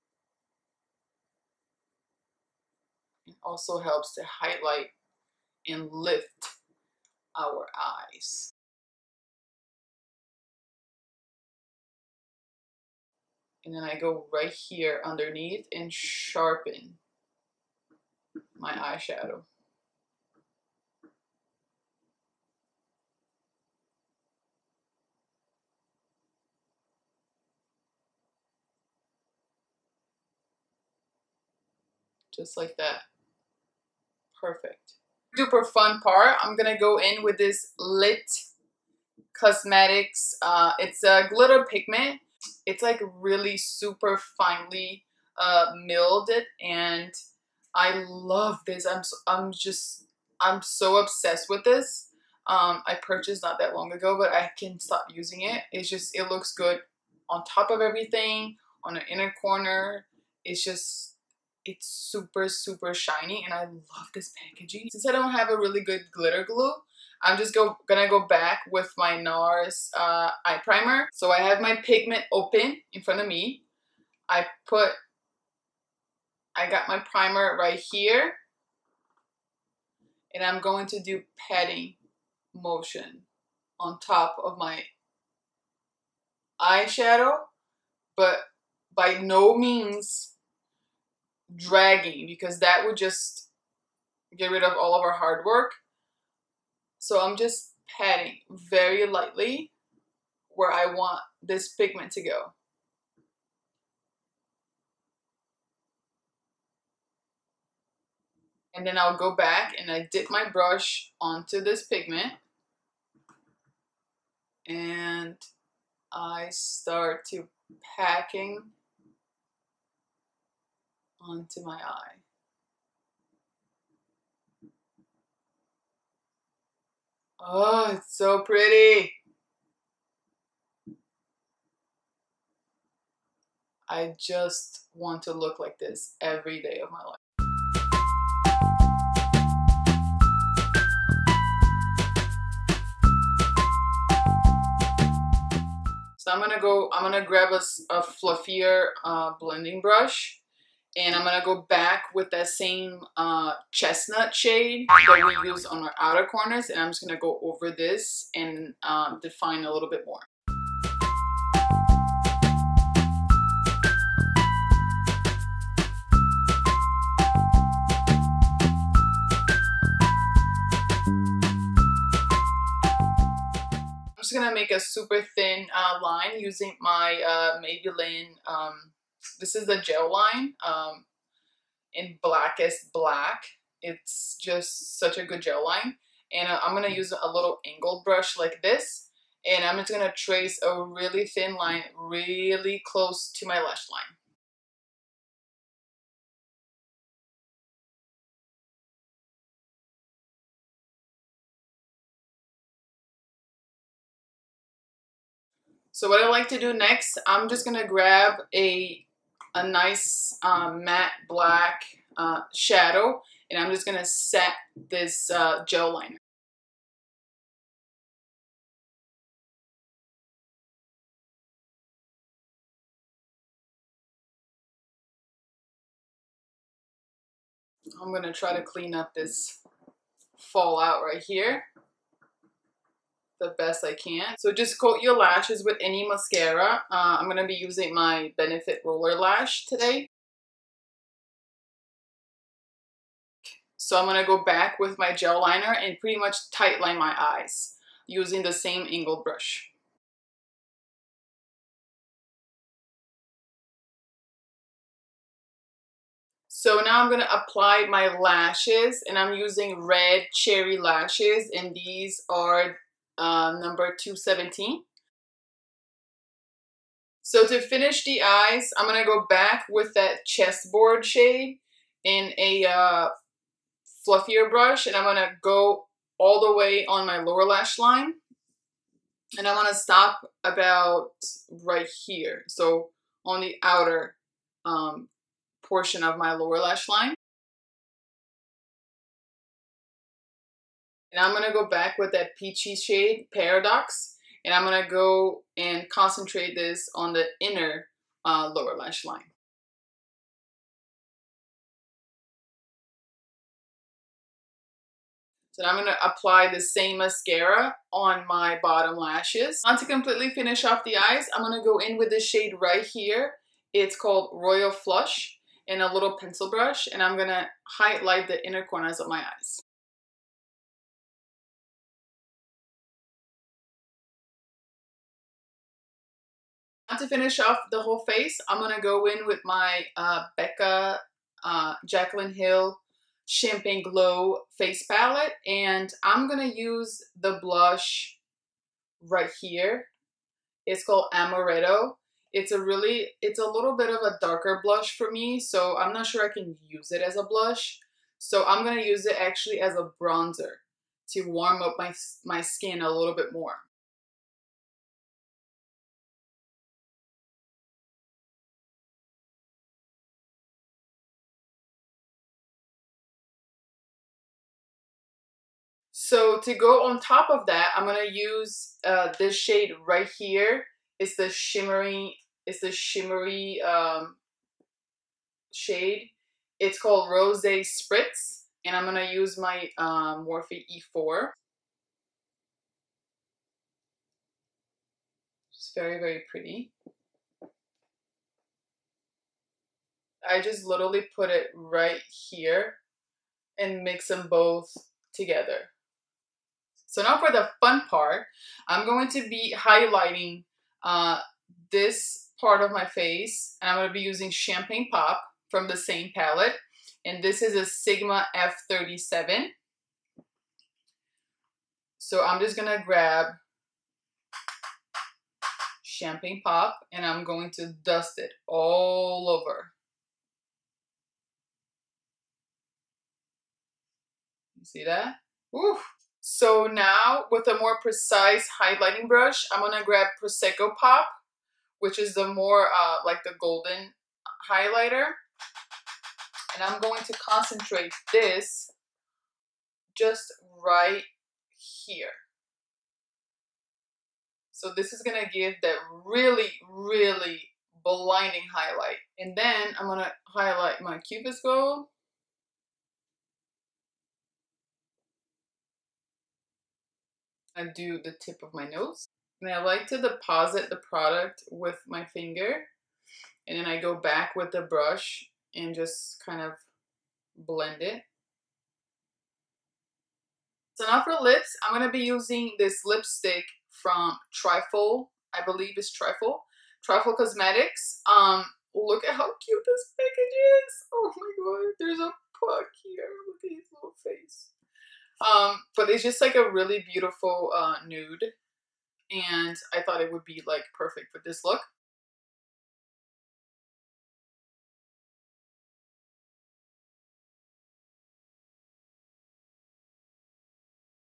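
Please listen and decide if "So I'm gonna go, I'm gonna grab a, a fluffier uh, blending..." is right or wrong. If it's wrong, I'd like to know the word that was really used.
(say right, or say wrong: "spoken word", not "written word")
right.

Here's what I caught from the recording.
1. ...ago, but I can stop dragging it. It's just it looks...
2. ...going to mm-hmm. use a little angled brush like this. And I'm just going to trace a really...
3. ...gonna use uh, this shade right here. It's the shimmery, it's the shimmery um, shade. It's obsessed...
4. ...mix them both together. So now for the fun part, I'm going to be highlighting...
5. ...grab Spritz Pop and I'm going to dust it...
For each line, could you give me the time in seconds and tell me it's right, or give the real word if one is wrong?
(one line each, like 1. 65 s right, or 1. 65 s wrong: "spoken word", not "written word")
1. 53 s wrong: "using", not "dragging"
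2. 186 s right
3. 367 s wrong: "called", not "obsessed"
4. 393 s right
5. 412 s wrong: "Champagne", not "Spritz".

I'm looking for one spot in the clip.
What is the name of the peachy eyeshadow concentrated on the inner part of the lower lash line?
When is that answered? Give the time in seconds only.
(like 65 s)
293 s.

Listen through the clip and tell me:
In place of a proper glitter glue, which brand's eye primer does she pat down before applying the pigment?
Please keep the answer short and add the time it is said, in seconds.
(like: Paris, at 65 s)
NARS, at 69 s.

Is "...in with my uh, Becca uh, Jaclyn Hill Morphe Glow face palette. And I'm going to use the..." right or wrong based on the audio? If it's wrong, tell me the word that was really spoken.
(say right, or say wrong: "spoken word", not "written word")
wrong: "Champagne", not "Morphe".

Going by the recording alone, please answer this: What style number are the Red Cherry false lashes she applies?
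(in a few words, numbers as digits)
217.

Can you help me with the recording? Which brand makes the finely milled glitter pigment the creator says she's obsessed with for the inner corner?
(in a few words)
Lit Cosmetics.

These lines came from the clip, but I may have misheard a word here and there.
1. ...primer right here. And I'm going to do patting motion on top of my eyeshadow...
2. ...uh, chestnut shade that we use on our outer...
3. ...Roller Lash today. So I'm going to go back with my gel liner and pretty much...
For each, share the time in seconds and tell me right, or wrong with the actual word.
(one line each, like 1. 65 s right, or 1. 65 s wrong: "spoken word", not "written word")
1. 76 s right
2. 153 s right
3. 238 s right.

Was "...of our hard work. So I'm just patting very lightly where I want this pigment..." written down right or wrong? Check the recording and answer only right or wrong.
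right.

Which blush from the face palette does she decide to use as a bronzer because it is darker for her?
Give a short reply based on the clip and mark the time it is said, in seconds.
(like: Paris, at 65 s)
Amaretto, at 341 s.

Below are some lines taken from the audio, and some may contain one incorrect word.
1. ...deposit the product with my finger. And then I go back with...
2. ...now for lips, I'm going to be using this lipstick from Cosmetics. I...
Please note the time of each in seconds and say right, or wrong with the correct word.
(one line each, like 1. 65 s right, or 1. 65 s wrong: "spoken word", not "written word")
1. 460 s right
2. 470 s wrong: "Trifle", not "Cosmetics".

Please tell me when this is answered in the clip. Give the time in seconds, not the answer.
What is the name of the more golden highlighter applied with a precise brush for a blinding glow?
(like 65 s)
430 s.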